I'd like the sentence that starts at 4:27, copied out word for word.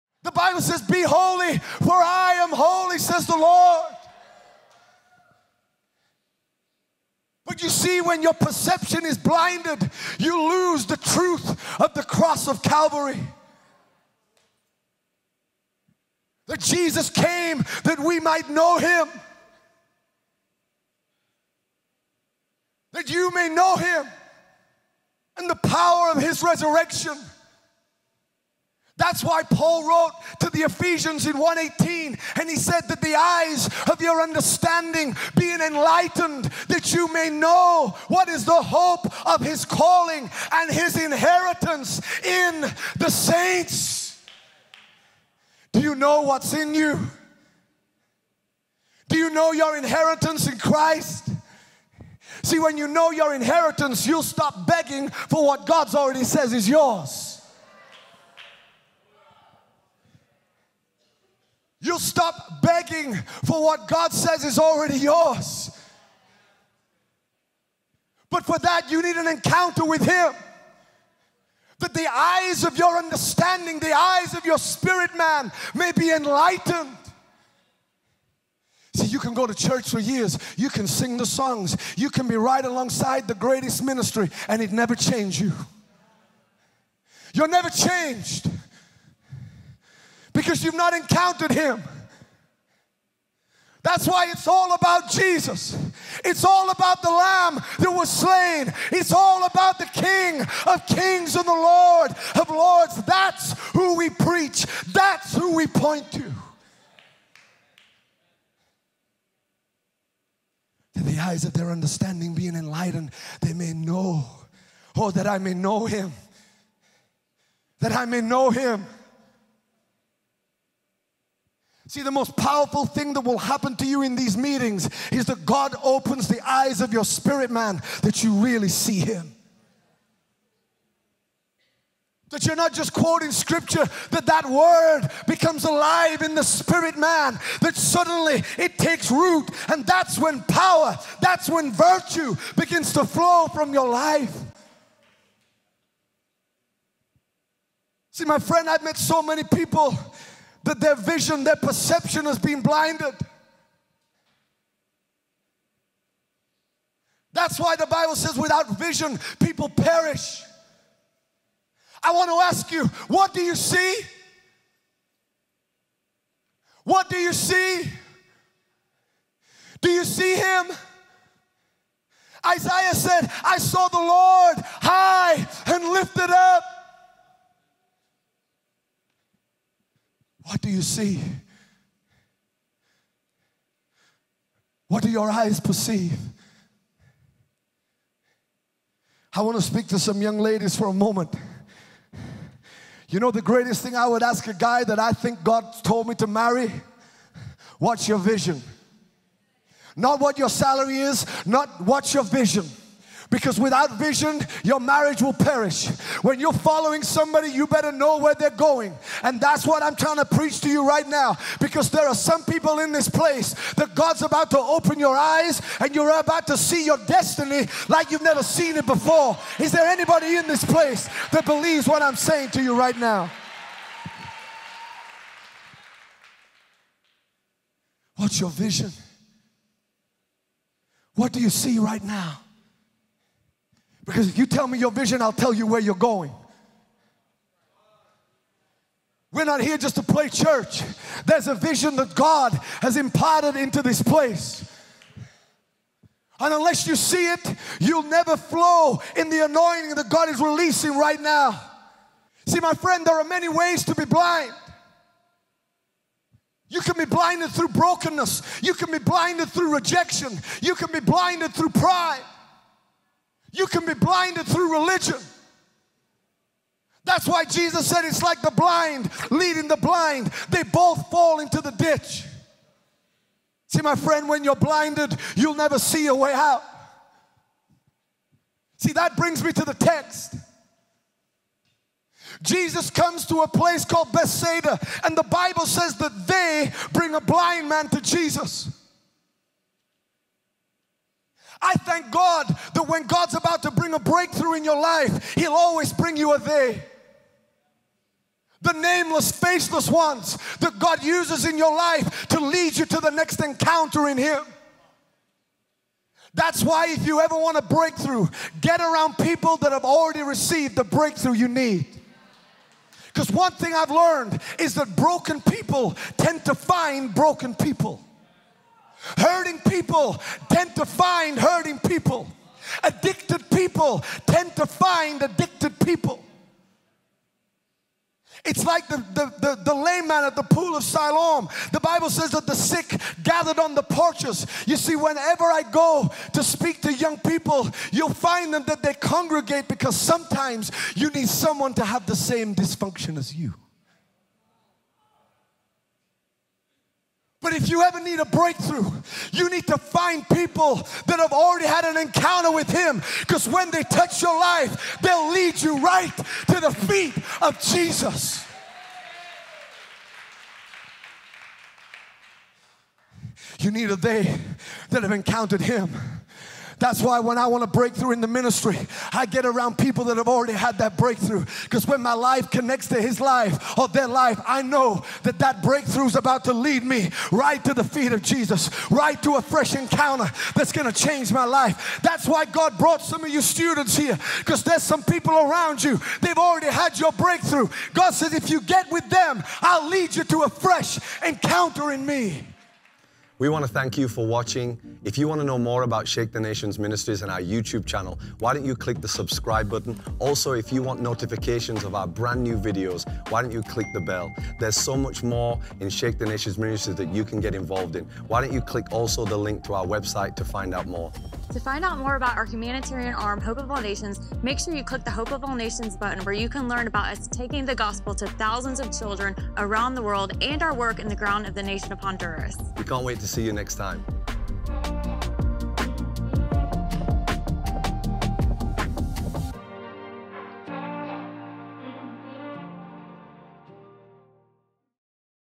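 That's why Jesus said it's like the blind leading the blind.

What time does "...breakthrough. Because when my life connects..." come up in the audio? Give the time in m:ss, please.
6:10.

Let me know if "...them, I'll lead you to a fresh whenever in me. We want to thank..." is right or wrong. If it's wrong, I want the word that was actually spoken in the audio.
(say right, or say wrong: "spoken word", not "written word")
wrong: "encounter", not "whenever".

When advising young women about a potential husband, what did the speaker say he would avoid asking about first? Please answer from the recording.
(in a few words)
Salary.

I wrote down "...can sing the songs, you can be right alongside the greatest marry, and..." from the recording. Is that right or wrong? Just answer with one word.
wrong.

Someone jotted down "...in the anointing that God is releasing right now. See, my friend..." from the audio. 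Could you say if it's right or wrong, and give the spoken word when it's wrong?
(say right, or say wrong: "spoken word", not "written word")
right.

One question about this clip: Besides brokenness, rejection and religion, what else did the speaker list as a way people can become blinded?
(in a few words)
Pride.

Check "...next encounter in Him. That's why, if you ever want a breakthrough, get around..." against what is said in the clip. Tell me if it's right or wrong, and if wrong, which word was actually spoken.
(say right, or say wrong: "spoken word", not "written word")
right.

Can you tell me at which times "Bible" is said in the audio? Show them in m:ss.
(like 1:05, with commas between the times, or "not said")
0:00, 2:37, 4:45, 5:31.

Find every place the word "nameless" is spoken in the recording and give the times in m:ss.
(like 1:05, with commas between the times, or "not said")
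4:58.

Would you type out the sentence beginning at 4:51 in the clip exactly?
I thank God that when God's about to bring a breakthrough in your life, He'll always bring you a they.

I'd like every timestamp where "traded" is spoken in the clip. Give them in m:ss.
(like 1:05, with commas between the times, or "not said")
not said.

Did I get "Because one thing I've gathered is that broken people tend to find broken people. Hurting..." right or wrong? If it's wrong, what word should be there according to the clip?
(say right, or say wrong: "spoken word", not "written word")
wrong: "learned", not "gathered".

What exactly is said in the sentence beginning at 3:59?
We're not here just to play church.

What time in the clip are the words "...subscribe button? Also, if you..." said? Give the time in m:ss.
6:39.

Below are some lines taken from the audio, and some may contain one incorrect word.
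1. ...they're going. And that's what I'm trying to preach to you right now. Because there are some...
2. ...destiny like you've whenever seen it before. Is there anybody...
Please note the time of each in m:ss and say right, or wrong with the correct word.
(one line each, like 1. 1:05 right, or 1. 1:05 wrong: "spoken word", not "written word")
1. 3:28 right
2. 3:37 wrong: "never", not "whenever".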